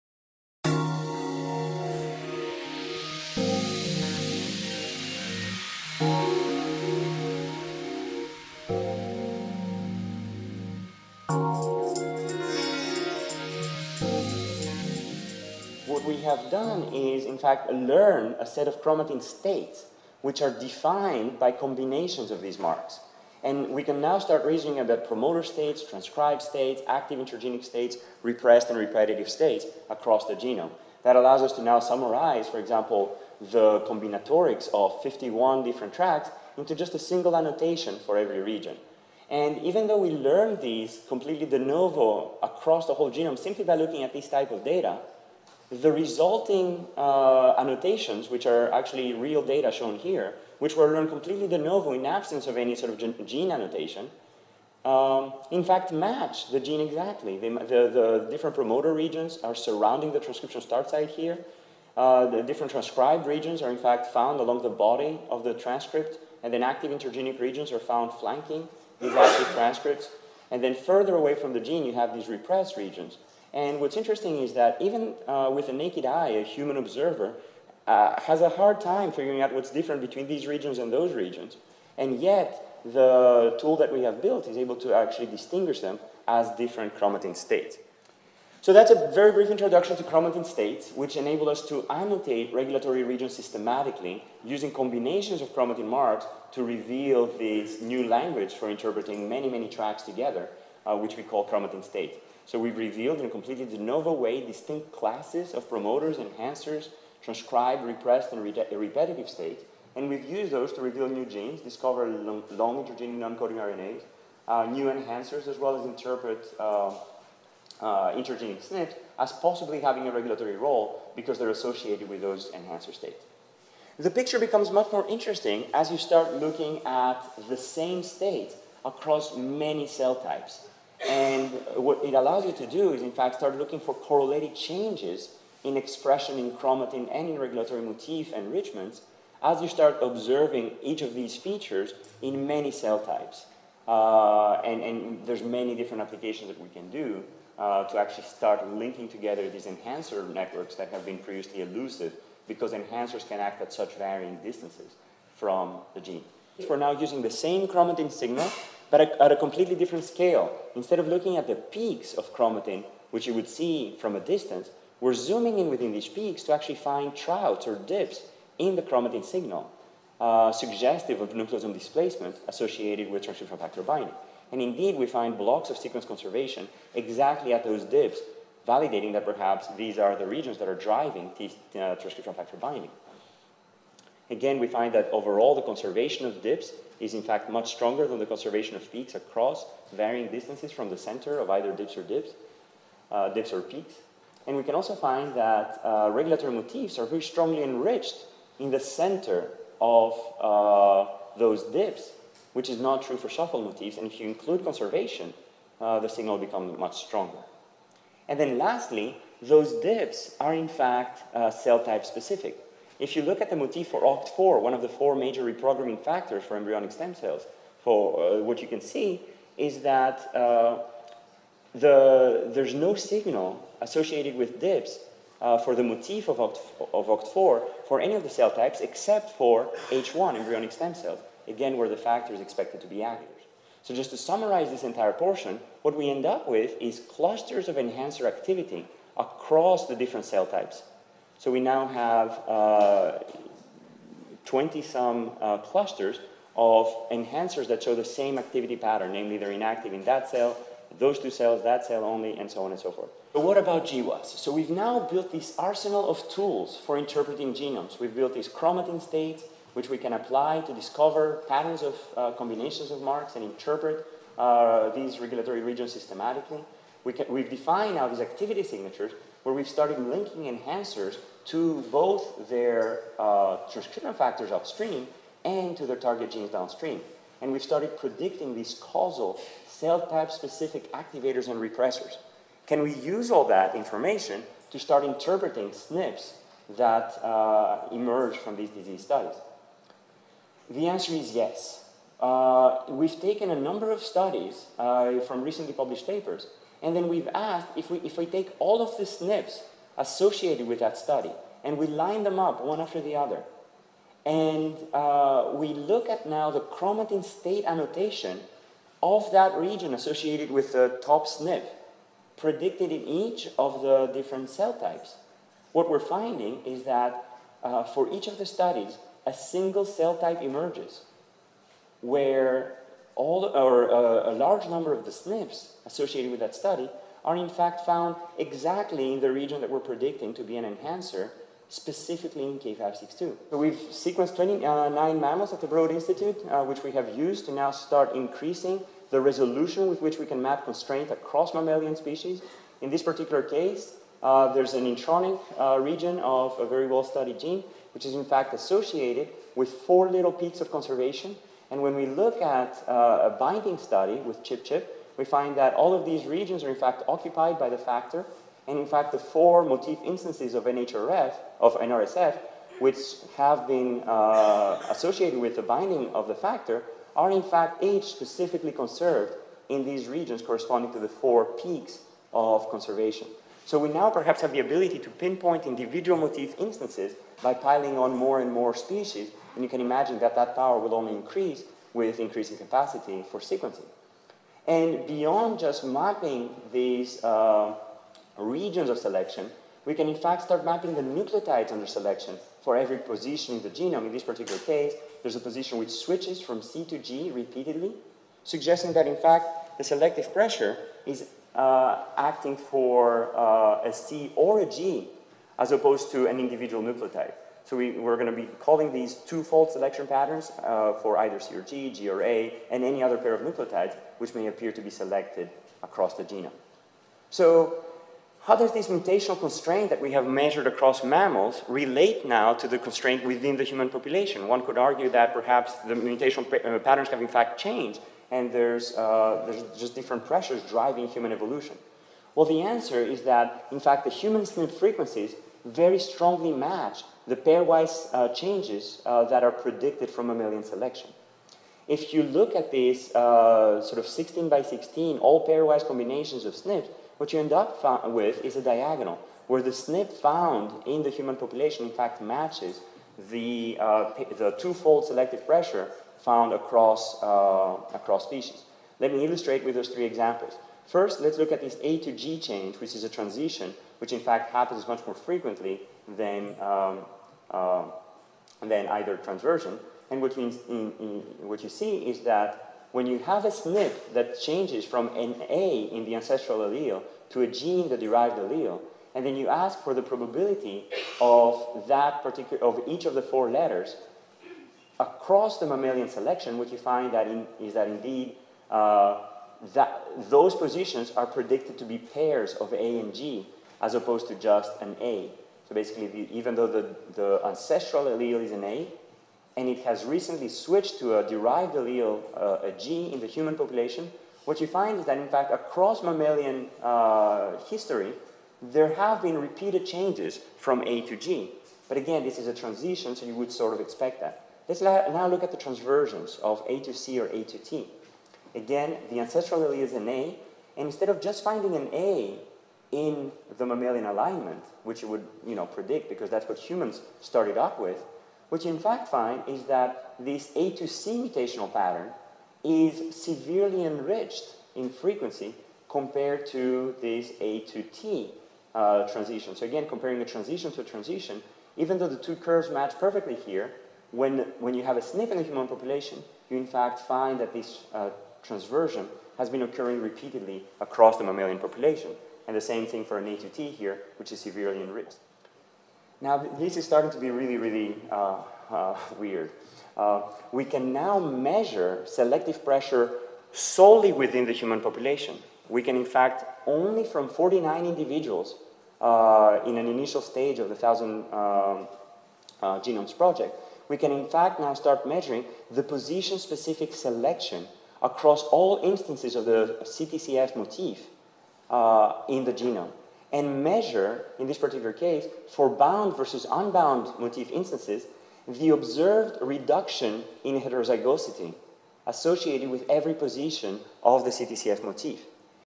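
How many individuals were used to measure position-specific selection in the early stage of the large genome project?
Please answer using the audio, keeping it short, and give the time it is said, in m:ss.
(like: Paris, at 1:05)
49, at 9:27.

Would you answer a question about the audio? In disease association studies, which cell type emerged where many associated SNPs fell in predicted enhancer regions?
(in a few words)
K562.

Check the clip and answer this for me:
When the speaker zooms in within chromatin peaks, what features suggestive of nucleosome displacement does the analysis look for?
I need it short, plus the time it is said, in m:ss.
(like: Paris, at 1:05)
troughs or dips, at 2:47.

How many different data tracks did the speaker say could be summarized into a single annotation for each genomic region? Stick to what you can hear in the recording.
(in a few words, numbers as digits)
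51.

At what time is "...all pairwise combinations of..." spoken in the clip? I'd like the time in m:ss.
7:25.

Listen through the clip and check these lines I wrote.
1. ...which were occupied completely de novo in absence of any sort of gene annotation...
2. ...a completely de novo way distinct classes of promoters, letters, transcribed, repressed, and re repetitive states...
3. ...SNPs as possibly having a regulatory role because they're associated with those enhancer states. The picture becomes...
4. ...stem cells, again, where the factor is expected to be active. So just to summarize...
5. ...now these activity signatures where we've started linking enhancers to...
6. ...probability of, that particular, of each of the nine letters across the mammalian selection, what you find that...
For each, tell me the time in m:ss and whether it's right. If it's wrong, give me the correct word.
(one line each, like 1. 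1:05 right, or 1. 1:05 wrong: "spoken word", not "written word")
1. 0:50 wrong: "learned", not "occupied"
2. 1:43 wrong: "enhancers", not "letters"
3. 1:58 right
4. 3:50 right
5. 4:27 right
6. 8:00 wrong: "four", not "nine".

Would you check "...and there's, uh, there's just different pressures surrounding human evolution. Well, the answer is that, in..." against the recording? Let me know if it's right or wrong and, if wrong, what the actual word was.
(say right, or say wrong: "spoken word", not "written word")
wrong: "driving", not "surrounding".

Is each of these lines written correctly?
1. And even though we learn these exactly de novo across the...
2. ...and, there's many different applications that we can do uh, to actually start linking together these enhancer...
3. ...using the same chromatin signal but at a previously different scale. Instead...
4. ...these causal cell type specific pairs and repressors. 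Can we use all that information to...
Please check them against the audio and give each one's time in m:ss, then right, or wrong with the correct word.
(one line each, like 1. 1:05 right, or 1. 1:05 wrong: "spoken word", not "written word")
1. 0:39 wrong: "completely", not "exactly"
2. 2:24 right
3. 2:36 wrong: "completely", not "previously"
4. 4:38 wrong: "activators", not "pairs".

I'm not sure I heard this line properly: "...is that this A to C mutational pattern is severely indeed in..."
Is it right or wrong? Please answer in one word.
wrong.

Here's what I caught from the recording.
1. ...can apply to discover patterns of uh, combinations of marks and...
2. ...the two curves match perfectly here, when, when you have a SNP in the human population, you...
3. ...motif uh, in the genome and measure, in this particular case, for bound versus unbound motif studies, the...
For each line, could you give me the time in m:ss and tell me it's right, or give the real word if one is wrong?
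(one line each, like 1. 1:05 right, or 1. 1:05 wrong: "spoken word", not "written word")
1. 4:19 right
2. 9:02 right
3. 9:40 wrong: "instances", not "studies".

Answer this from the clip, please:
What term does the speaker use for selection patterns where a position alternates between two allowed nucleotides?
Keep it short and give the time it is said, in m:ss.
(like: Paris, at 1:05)
two-fold selection, at 6:49.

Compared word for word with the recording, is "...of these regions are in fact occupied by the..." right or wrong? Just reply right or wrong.
right.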